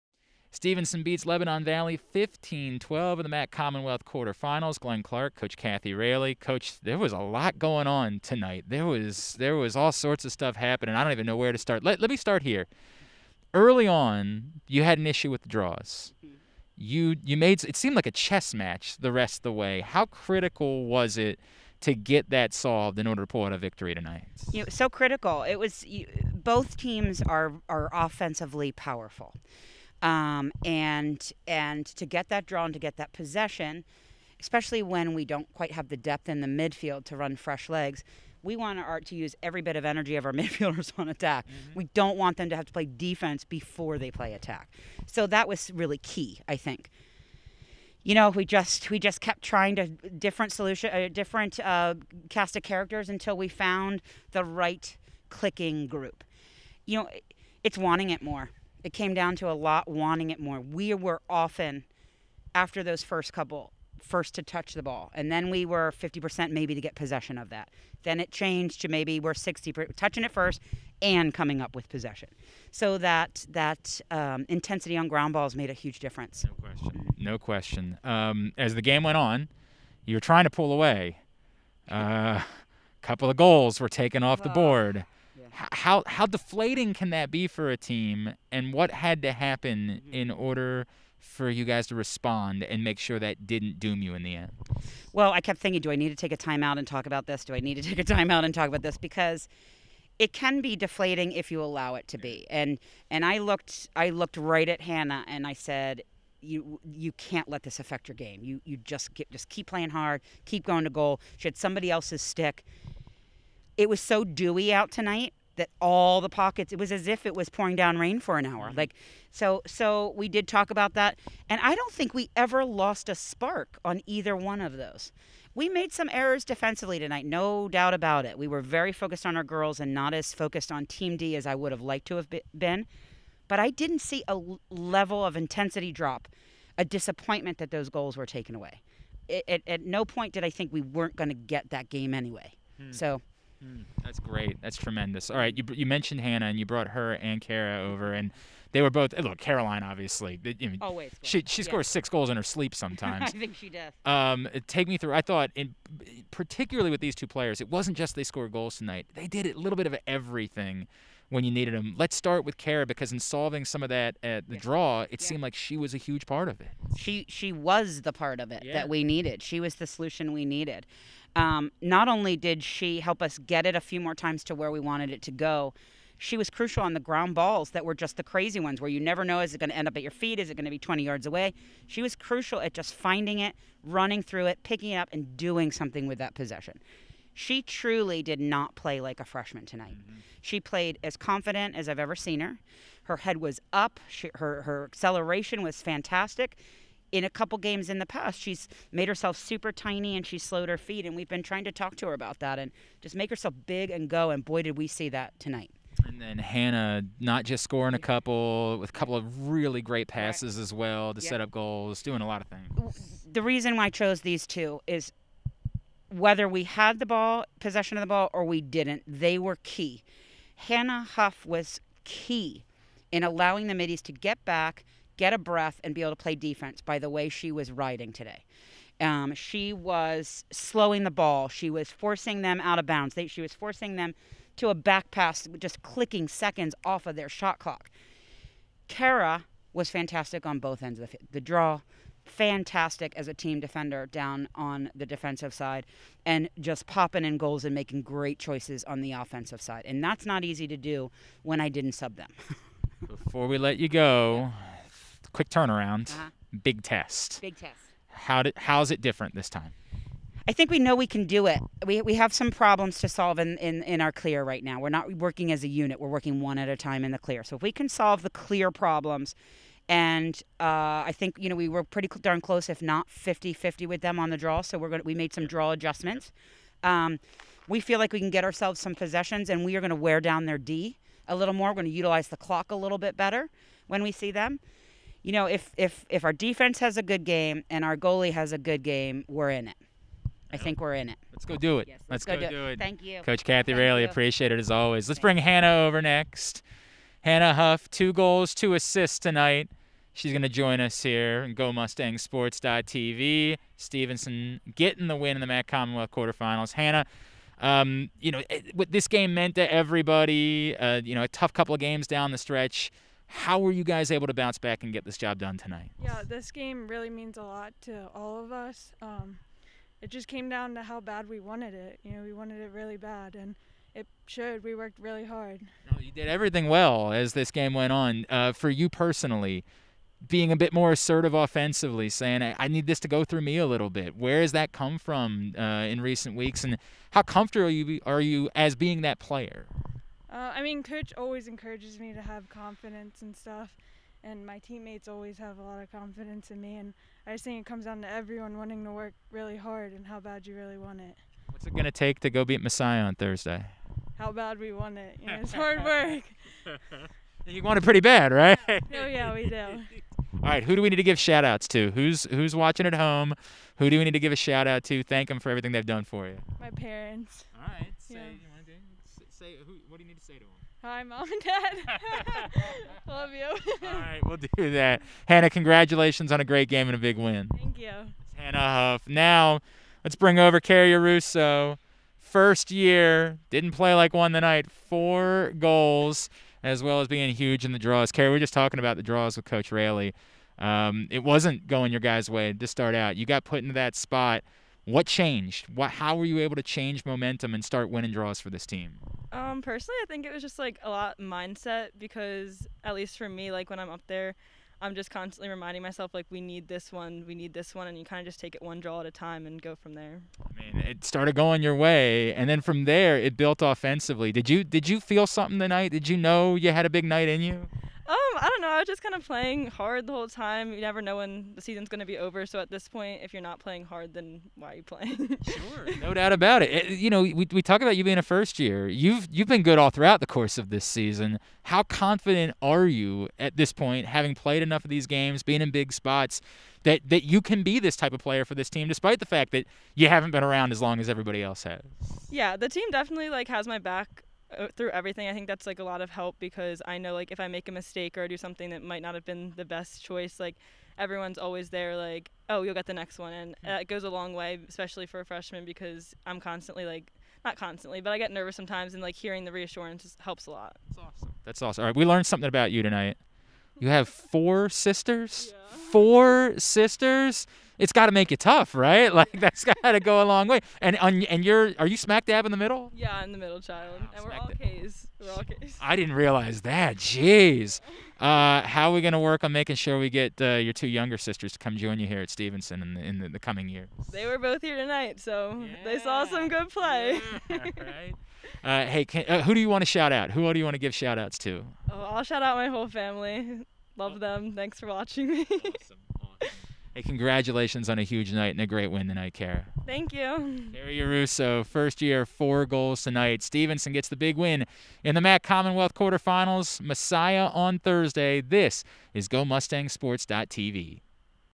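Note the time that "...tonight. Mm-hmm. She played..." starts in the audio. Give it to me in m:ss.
3:09.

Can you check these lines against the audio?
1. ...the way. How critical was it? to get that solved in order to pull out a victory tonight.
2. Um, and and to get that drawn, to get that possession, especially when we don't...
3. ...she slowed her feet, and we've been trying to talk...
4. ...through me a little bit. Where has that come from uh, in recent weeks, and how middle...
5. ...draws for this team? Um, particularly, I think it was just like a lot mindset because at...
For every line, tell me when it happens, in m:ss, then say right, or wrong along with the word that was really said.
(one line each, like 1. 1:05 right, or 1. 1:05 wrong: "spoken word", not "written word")
1. 0:19 right
2. 0:30 right
3. 3:20 right
4. 5:33 wrong: "comfortable", not "middle"
5. 6:38 wrong: "personally", not "particularly".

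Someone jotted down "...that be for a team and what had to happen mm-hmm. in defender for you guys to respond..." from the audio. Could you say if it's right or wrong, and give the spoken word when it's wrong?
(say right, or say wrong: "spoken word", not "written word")
wrong: "order", not "defender".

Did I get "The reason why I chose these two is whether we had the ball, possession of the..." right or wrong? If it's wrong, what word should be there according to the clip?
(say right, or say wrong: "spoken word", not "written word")
right.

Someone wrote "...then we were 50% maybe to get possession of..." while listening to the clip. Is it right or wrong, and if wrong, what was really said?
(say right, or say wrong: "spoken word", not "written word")
right.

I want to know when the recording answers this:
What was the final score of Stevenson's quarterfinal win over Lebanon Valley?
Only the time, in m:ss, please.
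0:01.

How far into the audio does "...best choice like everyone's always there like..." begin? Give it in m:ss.
7:29.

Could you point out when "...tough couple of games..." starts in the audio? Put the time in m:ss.
5:11.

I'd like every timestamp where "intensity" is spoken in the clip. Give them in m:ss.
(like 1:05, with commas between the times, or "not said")
1:14, 2:15.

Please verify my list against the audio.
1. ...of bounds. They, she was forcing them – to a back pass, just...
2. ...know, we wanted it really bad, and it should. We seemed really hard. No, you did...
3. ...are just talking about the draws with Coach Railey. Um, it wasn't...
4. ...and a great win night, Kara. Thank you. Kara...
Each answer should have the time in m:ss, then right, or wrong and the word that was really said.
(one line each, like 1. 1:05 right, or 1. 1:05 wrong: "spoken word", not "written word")
1. 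3:52 right
2. 5:22 wrong: "worked", not "seemed"
3. 6:28 right
4. 8:18 wrong: "tonight", not "night".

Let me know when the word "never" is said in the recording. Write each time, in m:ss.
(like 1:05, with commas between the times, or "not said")
2:58, 7:00.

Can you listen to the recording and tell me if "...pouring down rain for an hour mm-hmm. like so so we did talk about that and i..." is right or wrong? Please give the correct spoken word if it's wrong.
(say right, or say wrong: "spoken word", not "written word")
right.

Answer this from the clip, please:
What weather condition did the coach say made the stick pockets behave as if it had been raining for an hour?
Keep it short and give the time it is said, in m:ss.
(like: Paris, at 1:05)
Dewy, at 1:54.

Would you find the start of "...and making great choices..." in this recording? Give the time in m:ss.
4:07.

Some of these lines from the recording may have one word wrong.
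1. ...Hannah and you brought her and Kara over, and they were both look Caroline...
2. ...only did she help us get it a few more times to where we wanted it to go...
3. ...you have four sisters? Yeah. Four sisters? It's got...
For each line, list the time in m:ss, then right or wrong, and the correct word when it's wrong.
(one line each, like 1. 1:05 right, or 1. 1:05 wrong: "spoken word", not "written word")
1. 2:26 right
2. 2:52 right
3. 7:43 right.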